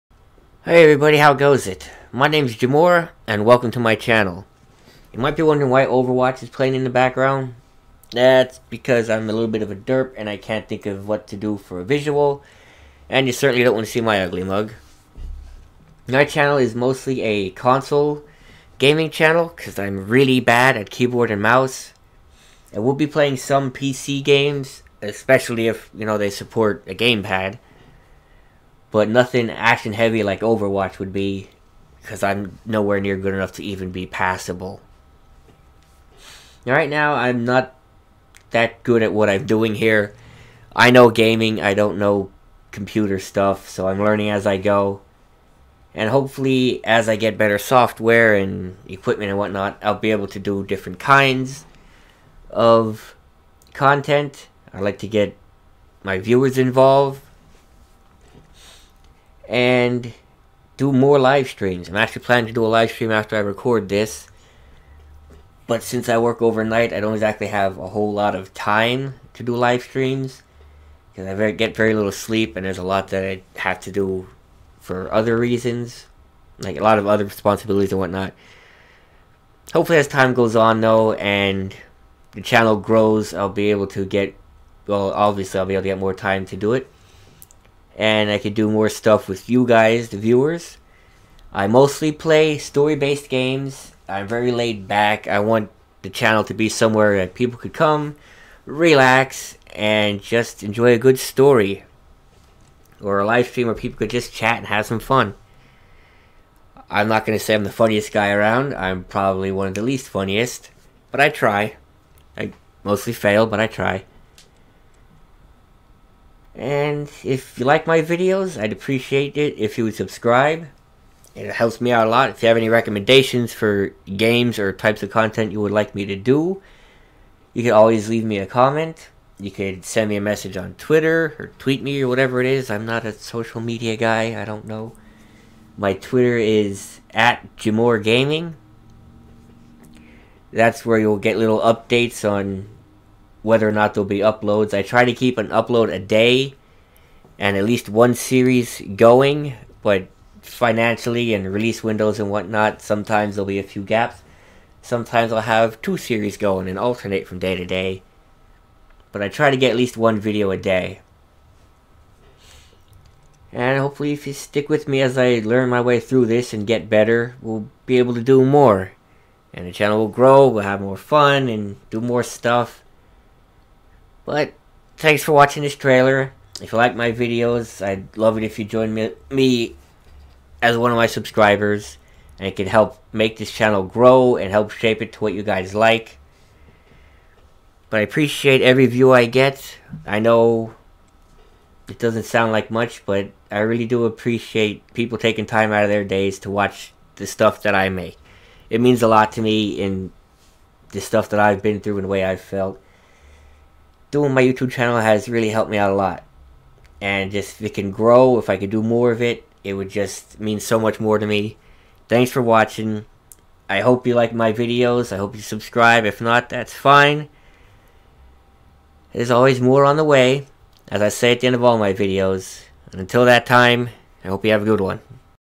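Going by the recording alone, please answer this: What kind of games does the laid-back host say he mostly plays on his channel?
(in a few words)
story based games.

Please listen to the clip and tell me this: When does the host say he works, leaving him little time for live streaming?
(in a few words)
overnight.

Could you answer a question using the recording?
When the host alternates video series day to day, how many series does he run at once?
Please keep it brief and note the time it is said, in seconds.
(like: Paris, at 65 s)
2, at 155 s.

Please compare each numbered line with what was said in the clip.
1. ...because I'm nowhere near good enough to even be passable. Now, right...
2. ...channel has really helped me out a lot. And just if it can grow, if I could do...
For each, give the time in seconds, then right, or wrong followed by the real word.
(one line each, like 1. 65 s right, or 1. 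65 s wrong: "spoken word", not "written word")
1. 32 s right
2. 204 s right.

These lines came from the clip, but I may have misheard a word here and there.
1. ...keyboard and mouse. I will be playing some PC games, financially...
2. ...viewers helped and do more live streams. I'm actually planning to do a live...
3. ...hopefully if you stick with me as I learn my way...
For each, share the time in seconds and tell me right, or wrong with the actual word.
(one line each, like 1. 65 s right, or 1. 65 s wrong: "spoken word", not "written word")
1. 20 s wrong: "especially", not "financially"
2. 56 s wrong: "involved", not "helped"
3. 163 s right.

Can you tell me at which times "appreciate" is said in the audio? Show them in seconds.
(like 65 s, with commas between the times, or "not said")
118 s, 188 s, 194 s.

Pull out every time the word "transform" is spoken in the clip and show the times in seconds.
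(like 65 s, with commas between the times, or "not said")
not said.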